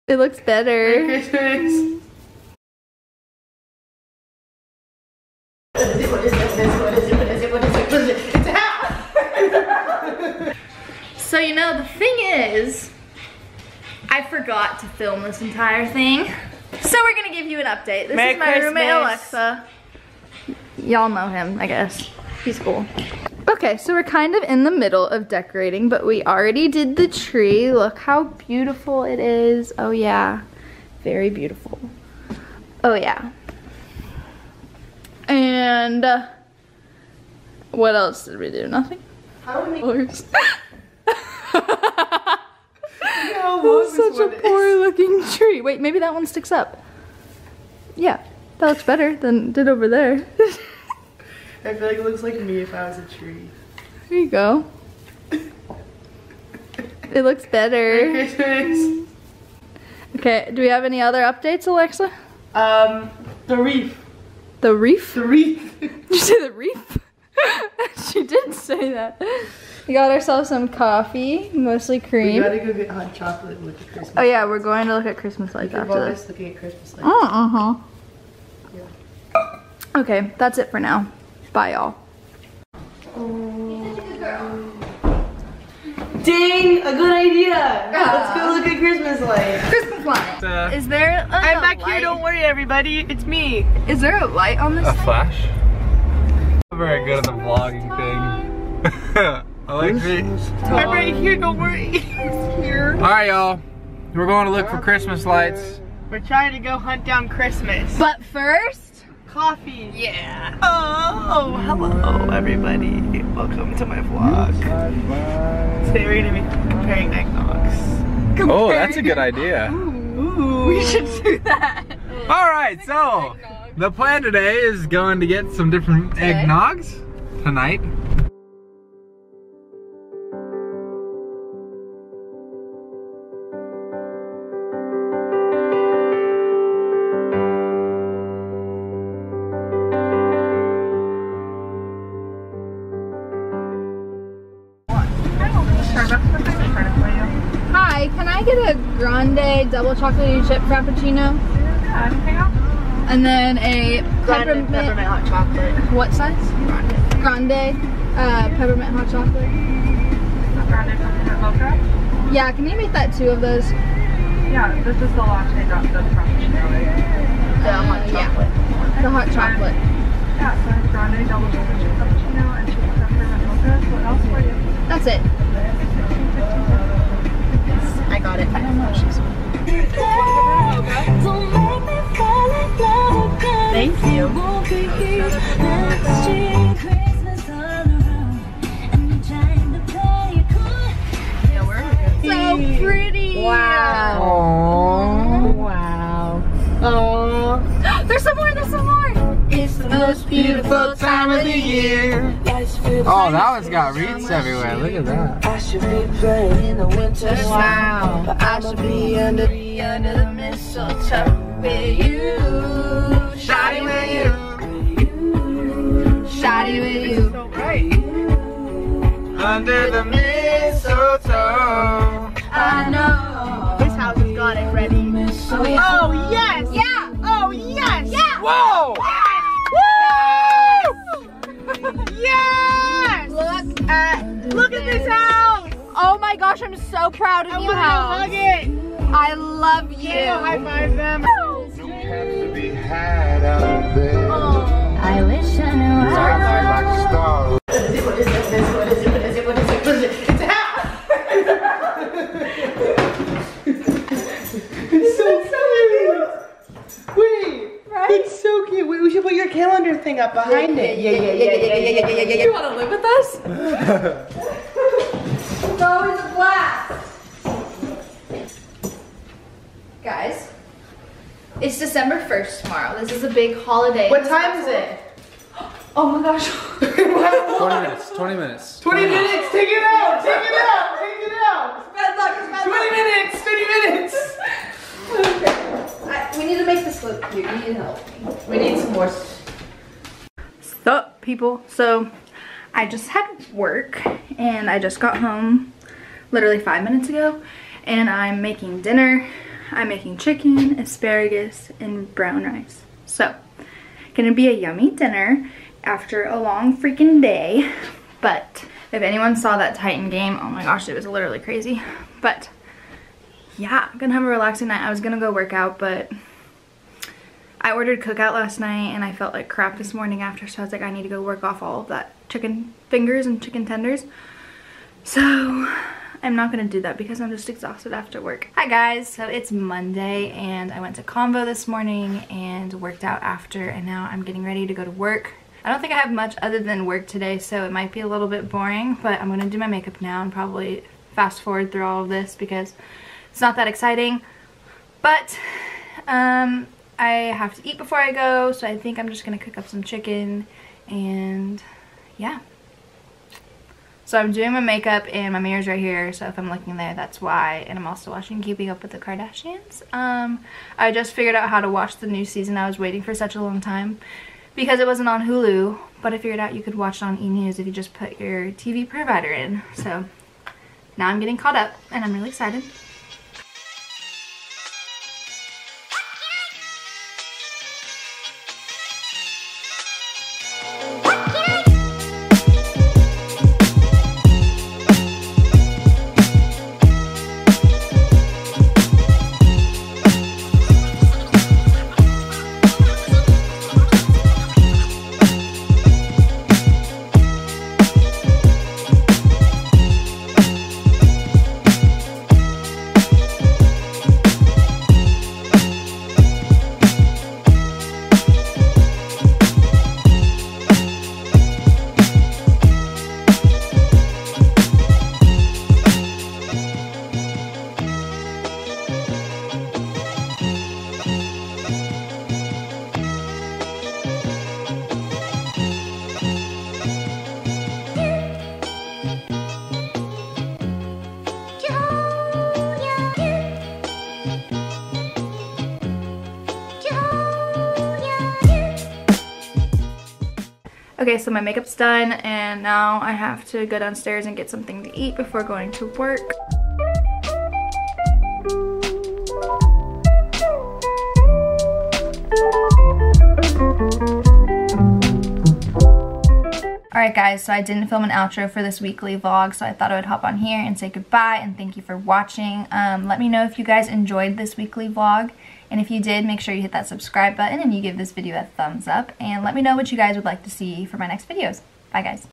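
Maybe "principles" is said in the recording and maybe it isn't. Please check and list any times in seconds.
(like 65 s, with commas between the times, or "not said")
not said.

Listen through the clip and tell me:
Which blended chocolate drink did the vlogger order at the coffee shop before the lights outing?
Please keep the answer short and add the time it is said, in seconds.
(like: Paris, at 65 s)
Double chocolate chip frappuccino, at 149 s.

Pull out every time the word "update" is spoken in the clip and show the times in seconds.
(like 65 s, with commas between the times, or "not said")
17 s, 61 s.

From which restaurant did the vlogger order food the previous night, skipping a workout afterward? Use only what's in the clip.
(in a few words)
Cookout.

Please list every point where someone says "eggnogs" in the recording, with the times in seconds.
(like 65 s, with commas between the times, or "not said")
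117 s, 126 s.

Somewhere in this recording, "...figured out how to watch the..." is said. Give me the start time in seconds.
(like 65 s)
361 s.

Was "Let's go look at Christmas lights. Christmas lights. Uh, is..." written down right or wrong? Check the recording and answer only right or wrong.
right.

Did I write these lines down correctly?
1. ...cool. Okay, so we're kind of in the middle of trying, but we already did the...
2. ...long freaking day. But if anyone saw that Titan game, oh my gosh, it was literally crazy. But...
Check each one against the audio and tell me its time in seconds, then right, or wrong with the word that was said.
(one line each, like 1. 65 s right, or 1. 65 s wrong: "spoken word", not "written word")
1. 22 s wrong: "decorating", not "trying"
2. 306 s right.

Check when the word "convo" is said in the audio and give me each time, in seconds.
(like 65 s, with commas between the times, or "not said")
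331 s.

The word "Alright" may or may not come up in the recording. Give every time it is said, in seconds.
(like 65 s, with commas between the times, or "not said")
102 s, 456 s.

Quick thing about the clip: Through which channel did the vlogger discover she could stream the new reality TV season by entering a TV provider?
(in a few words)
E! News.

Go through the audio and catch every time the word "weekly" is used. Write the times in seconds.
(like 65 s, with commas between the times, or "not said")
458 s, 464 s.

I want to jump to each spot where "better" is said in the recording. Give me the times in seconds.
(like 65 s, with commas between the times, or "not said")
0 s, 48 s, 57 s.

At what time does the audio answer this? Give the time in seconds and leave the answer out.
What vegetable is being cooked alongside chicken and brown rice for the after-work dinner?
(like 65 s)
300 s.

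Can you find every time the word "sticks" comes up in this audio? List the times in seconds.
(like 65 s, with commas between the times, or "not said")
46 s.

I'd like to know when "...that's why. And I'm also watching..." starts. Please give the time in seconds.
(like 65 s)
356 s.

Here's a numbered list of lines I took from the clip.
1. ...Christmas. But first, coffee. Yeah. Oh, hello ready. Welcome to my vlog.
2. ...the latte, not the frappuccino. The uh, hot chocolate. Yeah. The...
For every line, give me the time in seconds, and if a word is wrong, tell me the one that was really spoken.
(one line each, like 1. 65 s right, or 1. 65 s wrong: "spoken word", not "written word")
1. 107 s wrong: "everybody", not "ready"
2. 165 s right.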